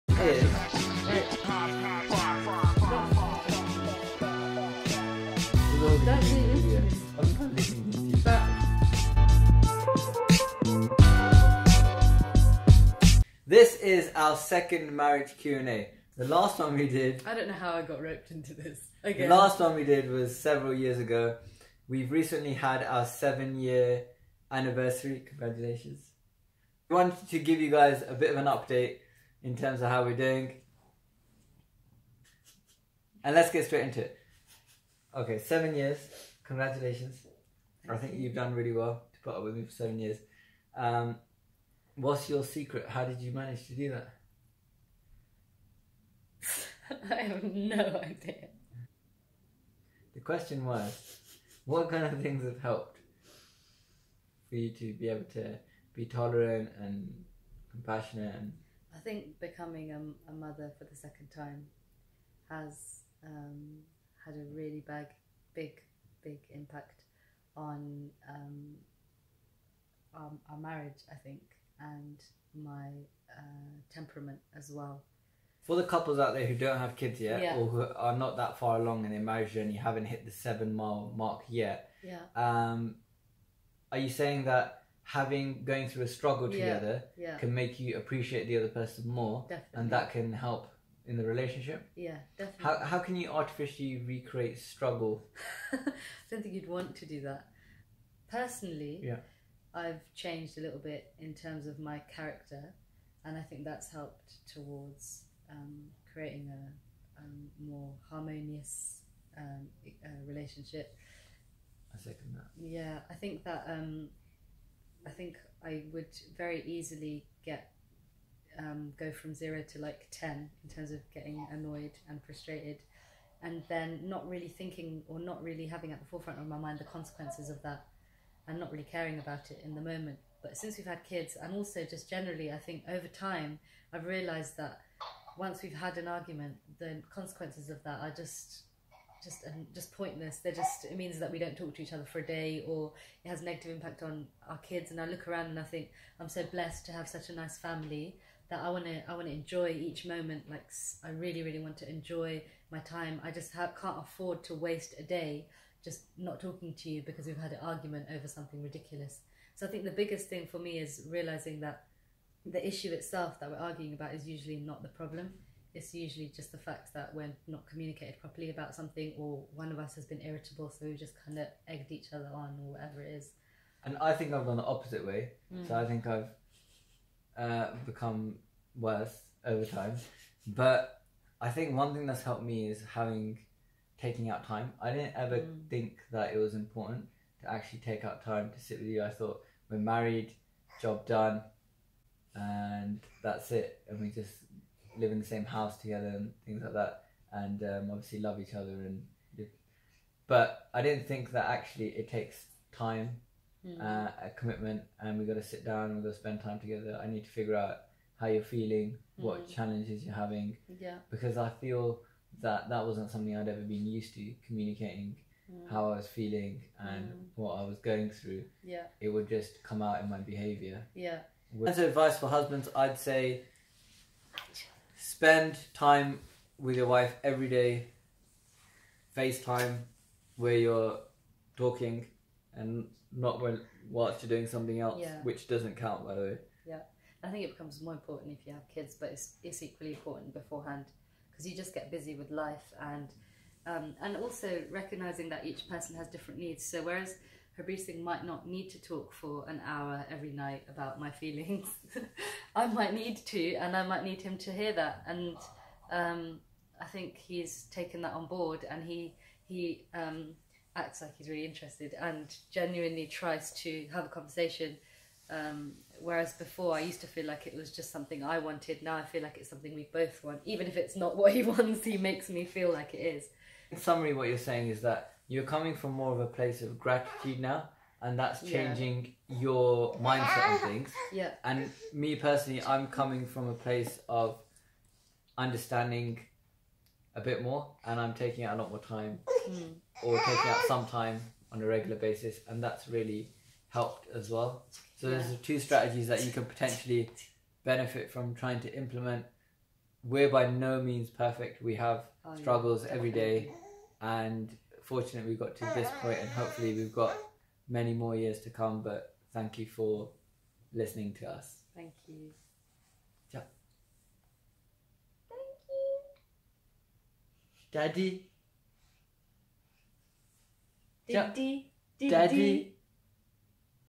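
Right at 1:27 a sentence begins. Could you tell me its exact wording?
can make you appreciate the other person more, definitely.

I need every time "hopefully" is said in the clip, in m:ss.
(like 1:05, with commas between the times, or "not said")
5:06.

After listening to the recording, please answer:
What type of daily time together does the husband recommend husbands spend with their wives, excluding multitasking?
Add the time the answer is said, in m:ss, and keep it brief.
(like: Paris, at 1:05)
FaceTime, at 3:49.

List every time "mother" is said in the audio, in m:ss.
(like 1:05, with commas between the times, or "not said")
1:00.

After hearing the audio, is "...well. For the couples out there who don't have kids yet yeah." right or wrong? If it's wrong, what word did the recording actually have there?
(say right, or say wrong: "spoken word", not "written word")
right.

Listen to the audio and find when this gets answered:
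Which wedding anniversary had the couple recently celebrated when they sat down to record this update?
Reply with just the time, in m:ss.
0:23.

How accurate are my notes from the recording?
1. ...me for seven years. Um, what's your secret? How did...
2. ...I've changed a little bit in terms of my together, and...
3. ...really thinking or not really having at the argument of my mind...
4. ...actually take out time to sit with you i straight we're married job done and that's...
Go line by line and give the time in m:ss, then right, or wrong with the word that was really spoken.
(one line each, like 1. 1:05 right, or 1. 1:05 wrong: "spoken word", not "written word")
1. 0:39 right
2. 1:39 wrong: "character", not "together"
3. 2:04 wrong: "forefront", not "argument"
4. 3:07 wrong: "thought", not "straight".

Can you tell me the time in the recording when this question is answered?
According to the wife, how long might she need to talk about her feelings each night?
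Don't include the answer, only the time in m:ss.
4:09.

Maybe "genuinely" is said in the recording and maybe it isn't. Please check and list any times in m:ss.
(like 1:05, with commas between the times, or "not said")
4:22.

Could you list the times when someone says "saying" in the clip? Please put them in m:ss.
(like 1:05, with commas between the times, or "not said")
1:24, 4:34.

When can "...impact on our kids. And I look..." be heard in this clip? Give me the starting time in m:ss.
2:23.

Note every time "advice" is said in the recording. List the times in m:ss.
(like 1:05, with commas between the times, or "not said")
3:41.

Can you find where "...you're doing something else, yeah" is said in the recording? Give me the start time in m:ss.
3:54.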